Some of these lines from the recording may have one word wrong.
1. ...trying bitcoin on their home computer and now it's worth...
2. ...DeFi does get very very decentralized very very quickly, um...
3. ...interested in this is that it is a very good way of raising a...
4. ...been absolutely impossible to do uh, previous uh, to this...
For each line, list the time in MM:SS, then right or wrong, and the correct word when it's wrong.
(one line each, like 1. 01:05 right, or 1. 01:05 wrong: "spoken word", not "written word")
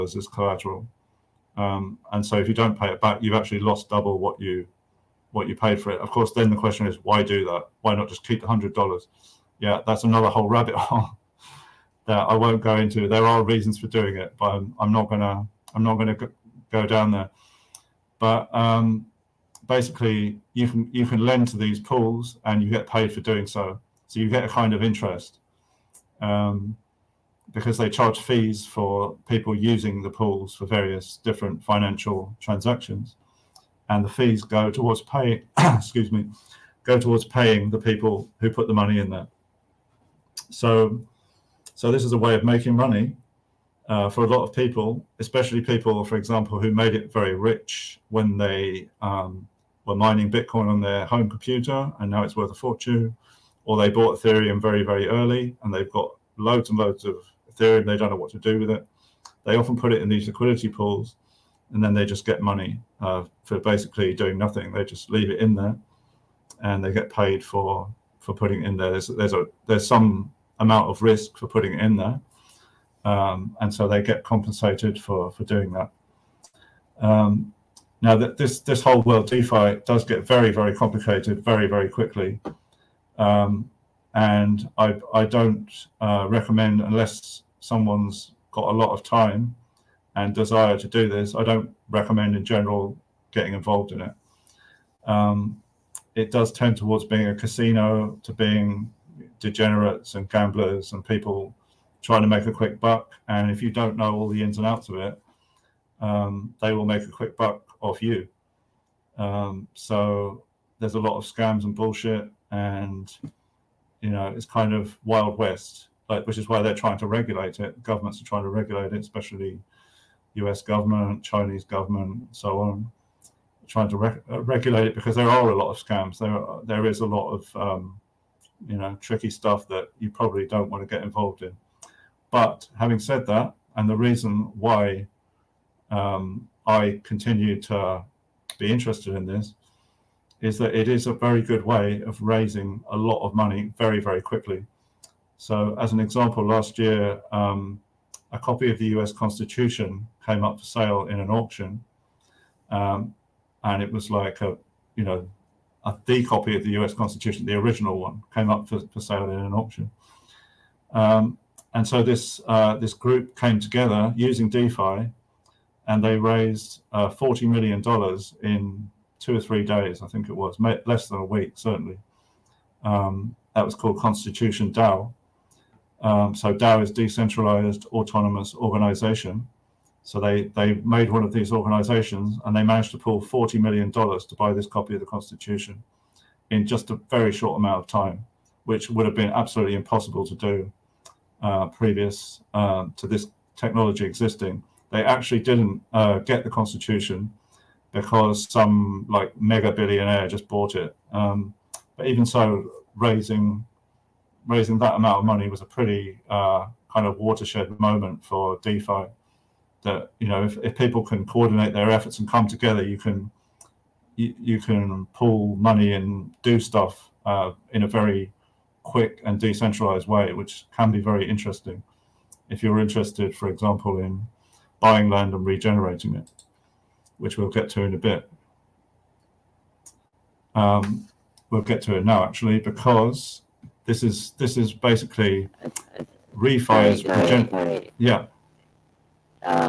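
1. 00:49 wrong: "mining", not "trying"
2. 01:19 wrong: "complicated", not "decentralized"
3. 02:18 right
4. 03:09 right.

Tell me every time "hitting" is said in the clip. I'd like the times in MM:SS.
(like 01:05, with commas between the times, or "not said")
not said.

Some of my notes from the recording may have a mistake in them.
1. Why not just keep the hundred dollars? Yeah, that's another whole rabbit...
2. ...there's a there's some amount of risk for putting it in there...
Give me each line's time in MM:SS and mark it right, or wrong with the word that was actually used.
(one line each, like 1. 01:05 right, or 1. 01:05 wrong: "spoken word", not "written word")
1. 00:07 right
2. 01:09 right.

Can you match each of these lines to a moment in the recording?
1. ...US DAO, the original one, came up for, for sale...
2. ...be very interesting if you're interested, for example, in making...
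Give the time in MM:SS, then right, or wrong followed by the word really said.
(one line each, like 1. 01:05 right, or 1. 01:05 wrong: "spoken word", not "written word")
1. 02:36 wrong: "Constitution", not "DAO"
2. 03:40 wrong: "buying", not "making".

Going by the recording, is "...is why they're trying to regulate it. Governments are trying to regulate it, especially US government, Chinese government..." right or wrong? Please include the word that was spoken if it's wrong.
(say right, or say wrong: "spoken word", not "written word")
right.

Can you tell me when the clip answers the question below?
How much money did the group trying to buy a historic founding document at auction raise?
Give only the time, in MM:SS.
02:47.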